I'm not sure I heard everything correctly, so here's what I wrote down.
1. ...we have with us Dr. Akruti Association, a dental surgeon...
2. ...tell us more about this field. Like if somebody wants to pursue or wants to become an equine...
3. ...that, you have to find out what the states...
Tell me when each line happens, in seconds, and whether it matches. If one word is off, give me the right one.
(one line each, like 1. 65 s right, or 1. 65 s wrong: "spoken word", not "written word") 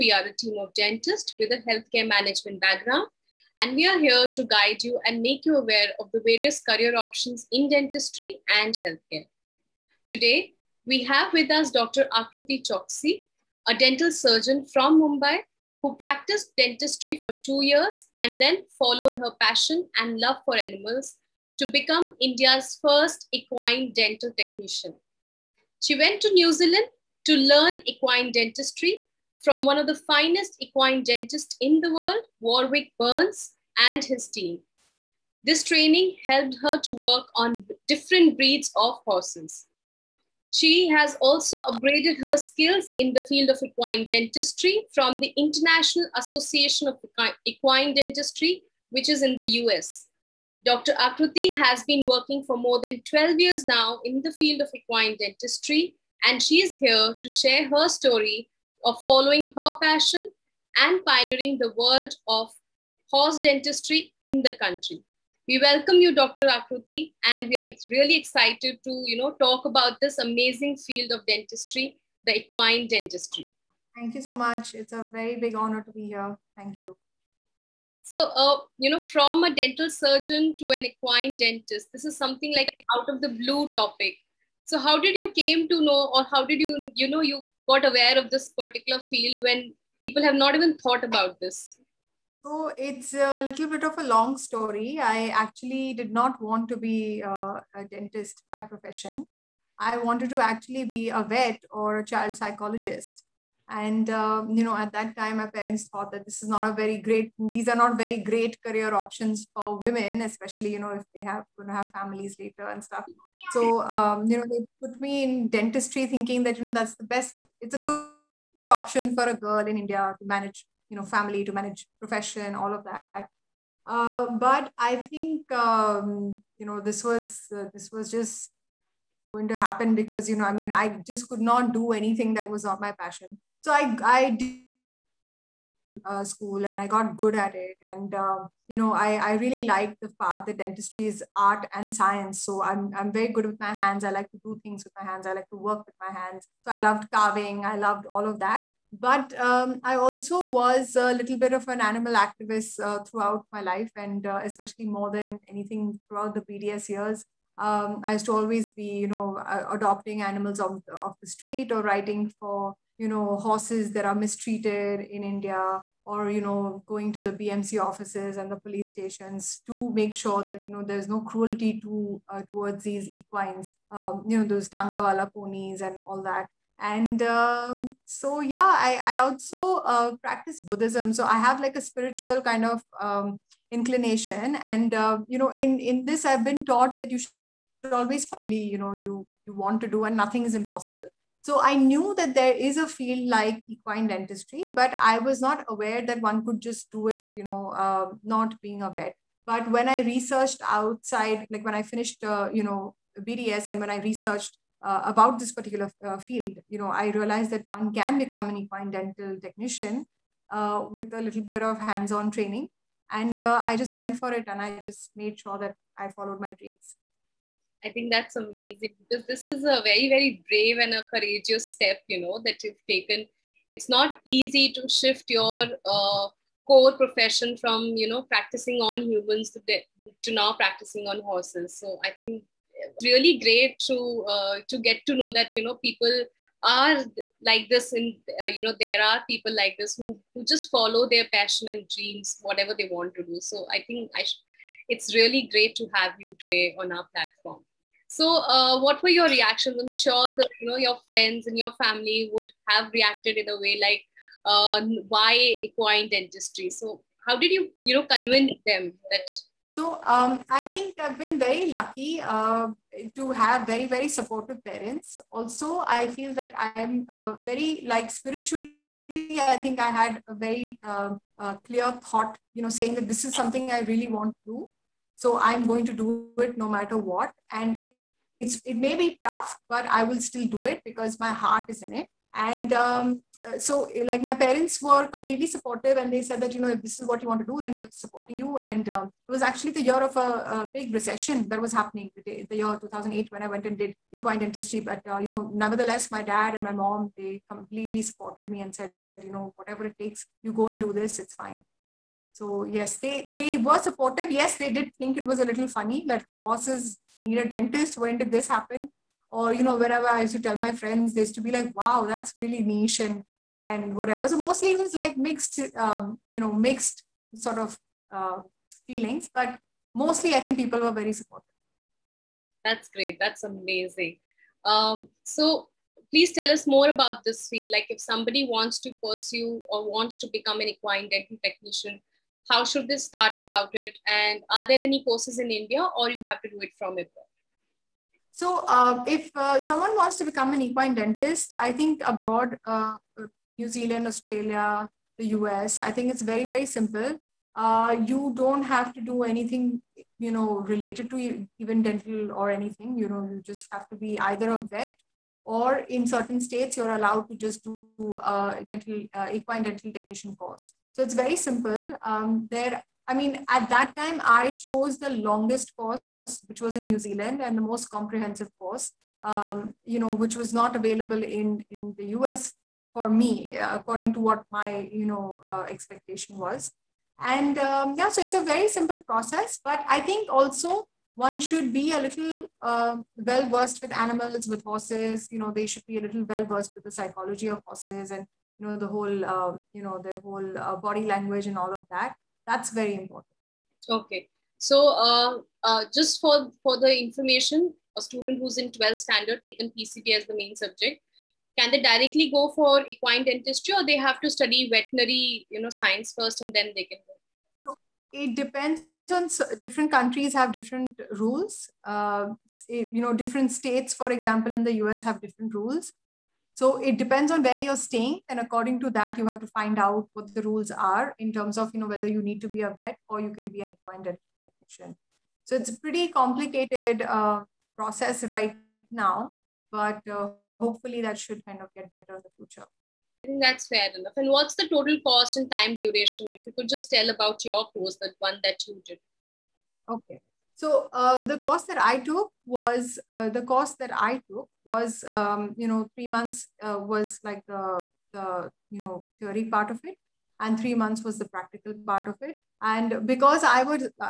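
1. 10 s wrong: "Choksi", not "Association"
2. 326 s right
3. 418 s wrong: "rules", not "states".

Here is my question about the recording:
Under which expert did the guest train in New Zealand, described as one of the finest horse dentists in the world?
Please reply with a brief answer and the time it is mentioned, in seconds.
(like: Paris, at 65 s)
Warwick Behrns, at 32 s.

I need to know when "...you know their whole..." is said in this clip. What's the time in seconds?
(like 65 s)
389 s.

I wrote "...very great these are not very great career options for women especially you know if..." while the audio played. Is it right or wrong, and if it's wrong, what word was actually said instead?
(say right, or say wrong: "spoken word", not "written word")
right.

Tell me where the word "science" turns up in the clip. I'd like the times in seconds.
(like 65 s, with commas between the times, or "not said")
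141 s, 405 s.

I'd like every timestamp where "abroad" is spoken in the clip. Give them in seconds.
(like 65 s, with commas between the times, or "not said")
336 s, 342 s.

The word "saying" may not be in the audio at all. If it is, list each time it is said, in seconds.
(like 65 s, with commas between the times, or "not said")
272 s.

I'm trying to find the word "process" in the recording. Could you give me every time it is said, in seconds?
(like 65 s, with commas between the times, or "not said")
379 s, 427 s.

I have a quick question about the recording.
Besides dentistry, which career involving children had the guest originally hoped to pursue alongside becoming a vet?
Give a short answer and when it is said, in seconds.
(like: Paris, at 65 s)
Child psychologist, at 102 s.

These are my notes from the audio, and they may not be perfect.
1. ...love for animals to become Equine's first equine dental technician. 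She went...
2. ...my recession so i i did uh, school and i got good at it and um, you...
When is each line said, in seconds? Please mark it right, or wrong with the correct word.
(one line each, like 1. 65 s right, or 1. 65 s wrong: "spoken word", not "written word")
1. 20 s wrong: "India", not "Equine"
2. 132 s wrong: "passion", not "recession".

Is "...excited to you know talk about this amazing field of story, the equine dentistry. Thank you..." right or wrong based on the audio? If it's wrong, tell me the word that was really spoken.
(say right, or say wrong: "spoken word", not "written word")
wrong: "dentistry", not "story".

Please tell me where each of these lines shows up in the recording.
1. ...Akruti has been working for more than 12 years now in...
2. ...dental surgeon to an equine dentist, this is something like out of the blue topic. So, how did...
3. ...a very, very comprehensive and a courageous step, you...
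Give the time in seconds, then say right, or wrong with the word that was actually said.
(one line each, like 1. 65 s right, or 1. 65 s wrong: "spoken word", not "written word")
1. 50 s right
2. 79 s right
3. 219 s wrong: "brave", not "comprehensive".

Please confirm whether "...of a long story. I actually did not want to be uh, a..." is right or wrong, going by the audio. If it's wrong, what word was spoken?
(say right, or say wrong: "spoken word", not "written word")
right.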